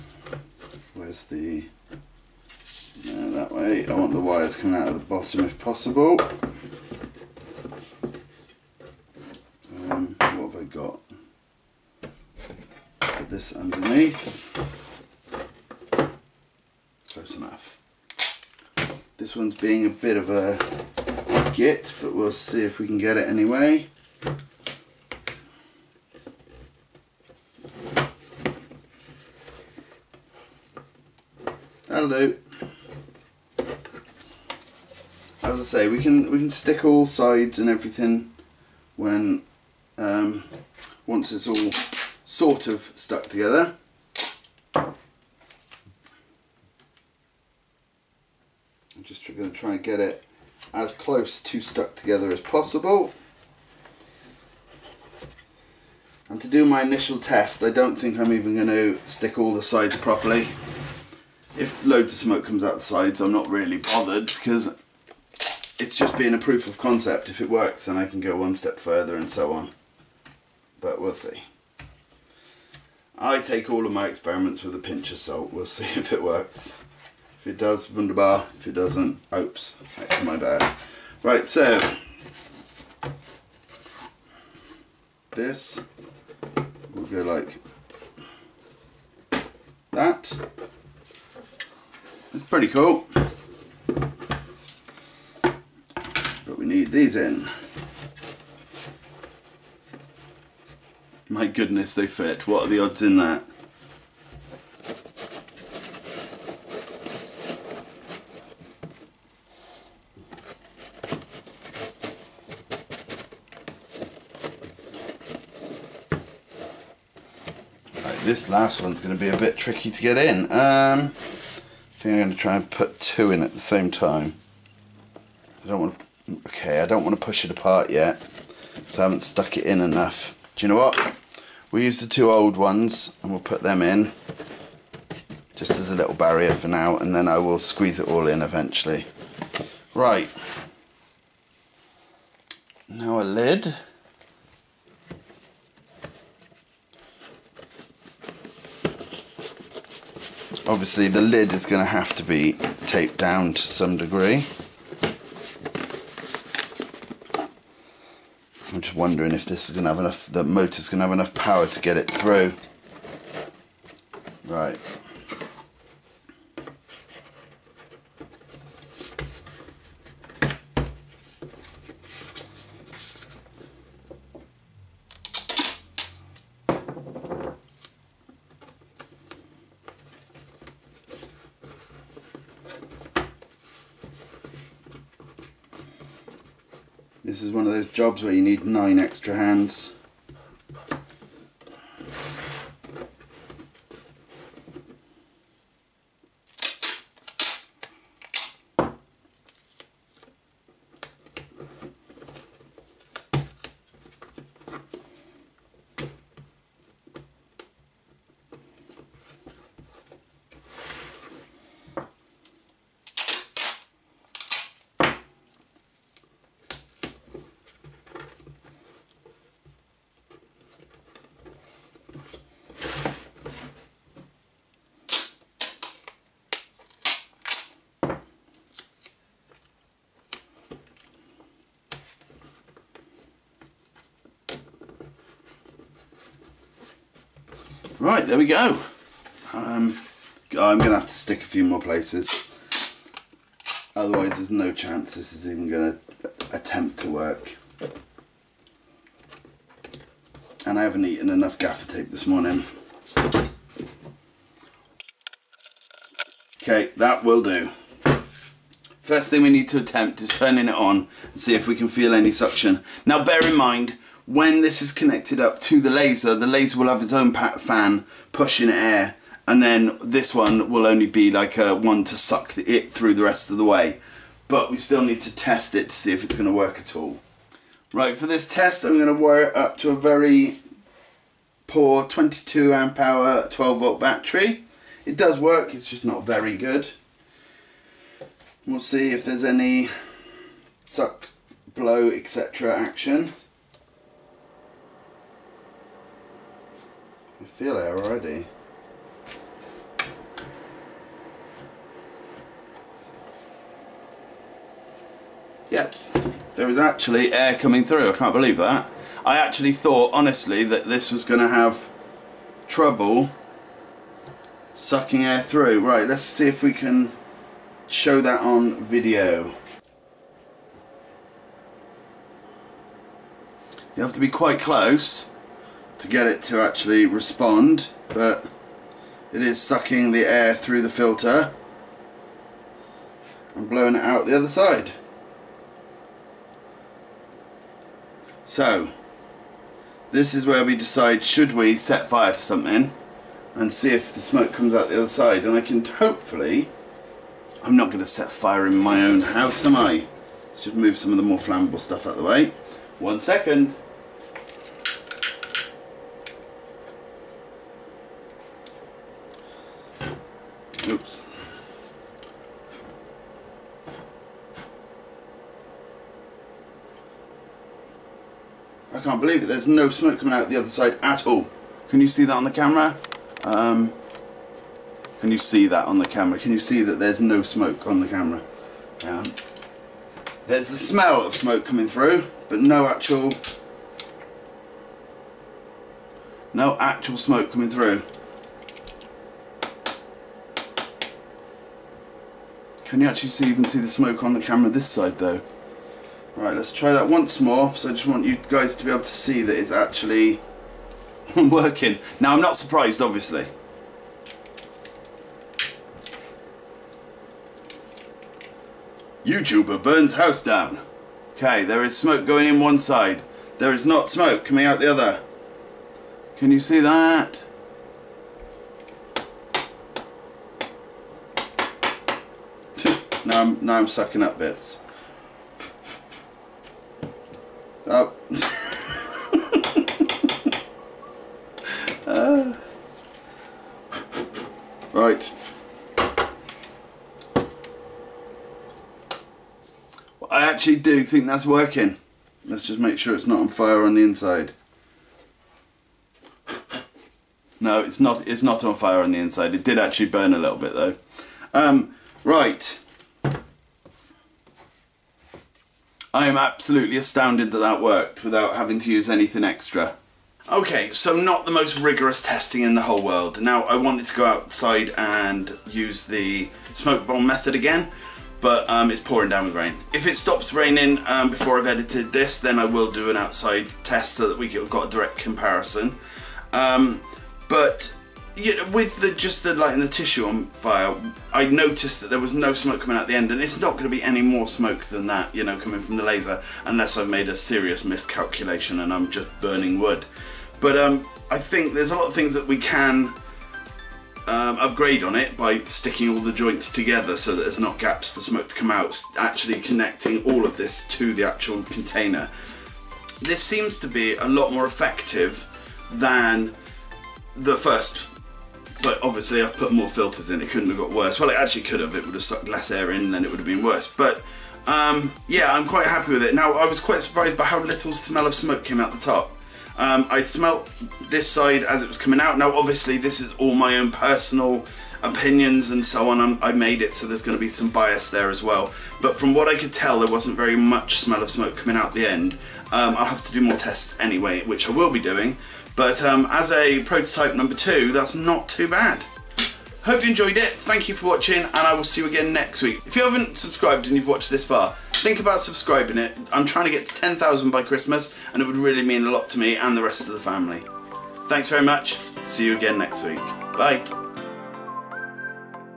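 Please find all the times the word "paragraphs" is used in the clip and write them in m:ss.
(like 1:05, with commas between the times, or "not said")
not said.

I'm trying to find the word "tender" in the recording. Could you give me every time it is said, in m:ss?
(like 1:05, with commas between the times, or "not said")
not said.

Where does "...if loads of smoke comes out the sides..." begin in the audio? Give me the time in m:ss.
1:01.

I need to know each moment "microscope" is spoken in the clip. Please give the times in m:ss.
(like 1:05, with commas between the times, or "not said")
not said.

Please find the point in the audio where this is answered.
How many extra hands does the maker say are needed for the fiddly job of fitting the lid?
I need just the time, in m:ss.
3:08.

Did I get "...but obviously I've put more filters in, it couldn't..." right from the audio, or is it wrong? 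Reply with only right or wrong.
right.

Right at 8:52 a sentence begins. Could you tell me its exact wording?
Um, I'll have to do more tests anyway, which I will be doing.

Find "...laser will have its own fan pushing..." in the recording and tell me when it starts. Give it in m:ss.
4:26.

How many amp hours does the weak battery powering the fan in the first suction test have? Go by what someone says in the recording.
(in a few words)
22 amp hour.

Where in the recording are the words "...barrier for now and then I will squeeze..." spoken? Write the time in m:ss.
2:16.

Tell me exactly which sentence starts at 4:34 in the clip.
But we still need to test it to see if it's going to work at all.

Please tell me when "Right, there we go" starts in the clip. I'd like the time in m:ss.
3:58.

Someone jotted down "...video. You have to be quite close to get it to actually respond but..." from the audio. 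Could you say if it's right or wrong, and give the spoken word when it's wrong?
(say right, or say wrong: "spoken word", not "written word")
right.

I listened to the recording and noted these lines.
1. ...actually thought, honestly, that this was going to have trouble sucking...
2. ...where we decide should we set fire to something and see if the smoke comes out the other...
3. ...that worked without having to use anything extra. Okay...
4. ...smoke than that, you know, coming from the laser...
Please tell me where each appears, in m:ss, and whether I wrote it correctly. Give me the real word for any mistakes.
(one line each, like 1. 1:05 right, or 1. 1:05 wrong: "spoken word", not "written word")
1. 5:09 right
2. 5:40 right
3. 7:37 right
4. 8:04 right.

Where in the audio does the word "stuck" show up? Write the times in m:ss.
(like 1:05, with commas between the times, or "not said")
0:42, 0:51, 2:09.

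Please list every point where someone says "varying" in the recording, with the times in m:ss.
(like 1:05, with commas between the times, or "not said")
not said.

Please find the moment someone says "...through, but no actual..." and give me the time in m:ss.
6:21.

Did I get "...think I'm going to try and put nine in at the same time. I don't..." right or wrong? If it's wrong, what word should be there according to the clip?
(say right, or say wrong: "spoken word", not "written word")
wrong: "two", not "nine".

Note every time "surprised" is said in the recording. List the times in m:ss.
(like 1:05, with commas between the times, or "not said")
6:42, 8:37.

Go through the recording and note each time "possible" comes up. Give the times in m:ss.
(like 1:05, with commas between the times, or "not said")
0:05, 0:52.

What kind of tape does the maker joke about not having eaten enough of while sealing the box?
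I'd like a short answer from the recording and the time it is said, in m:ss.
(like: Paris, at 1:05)
gaffer tape, at 4:11.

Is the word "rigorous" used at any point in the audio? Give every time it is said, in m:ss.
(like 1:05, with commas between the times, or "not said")
7:41.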